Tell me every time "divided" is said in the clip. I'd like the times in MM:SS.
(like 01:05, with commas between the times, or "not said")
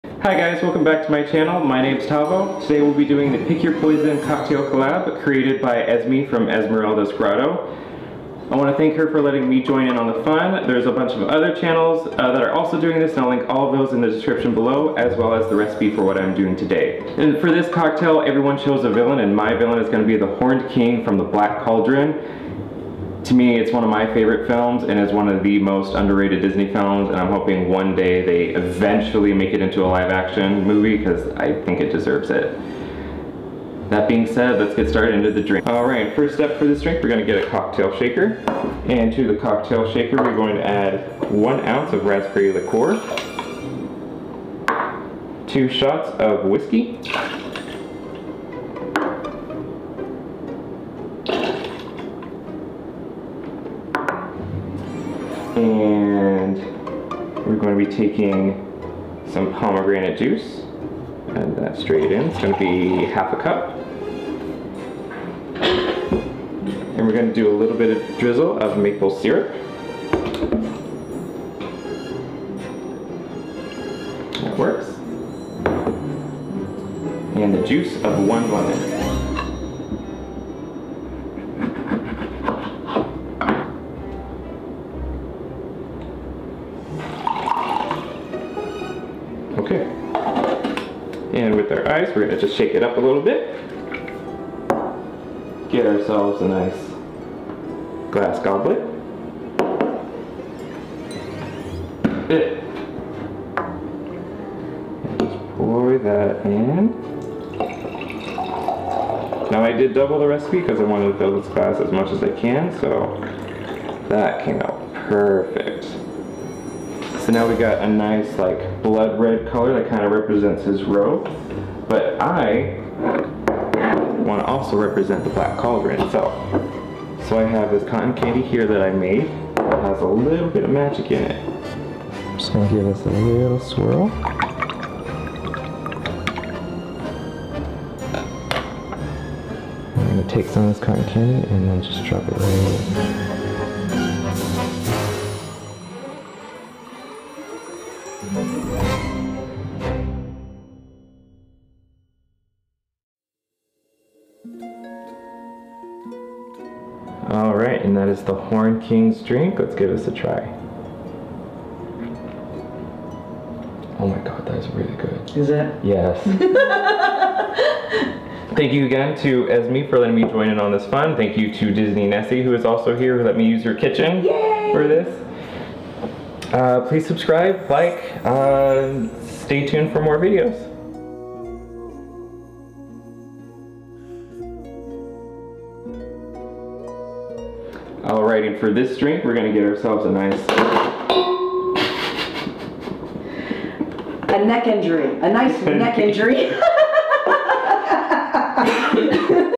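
not said.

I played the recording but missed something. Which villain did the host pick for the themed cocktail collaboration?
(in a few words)
The Horned King.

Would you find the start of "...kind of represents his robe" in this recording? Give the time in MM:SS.
01:59.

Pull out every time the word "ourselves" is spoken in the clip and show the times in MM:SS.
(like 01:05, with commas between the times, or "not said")
01:35, 03:09.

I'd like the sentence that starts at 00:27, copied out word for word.
And I'm hoping one day they eventually make it into a live action movie because I think it deserves it.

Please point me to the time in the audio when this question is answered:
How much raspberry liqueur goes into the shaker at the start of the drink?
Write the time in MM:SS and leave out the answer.
00:41.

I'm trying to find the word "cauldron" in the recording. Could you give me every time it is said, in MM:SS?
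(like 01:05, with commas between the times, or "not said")
00:21, 02:05.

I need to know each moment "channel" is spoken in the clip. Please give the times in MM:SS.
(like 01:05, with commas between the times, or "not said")
00:01, 00:11.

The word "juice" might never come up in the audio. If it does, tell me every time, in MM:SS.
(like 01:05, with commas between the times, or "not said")
01:00, 01:17.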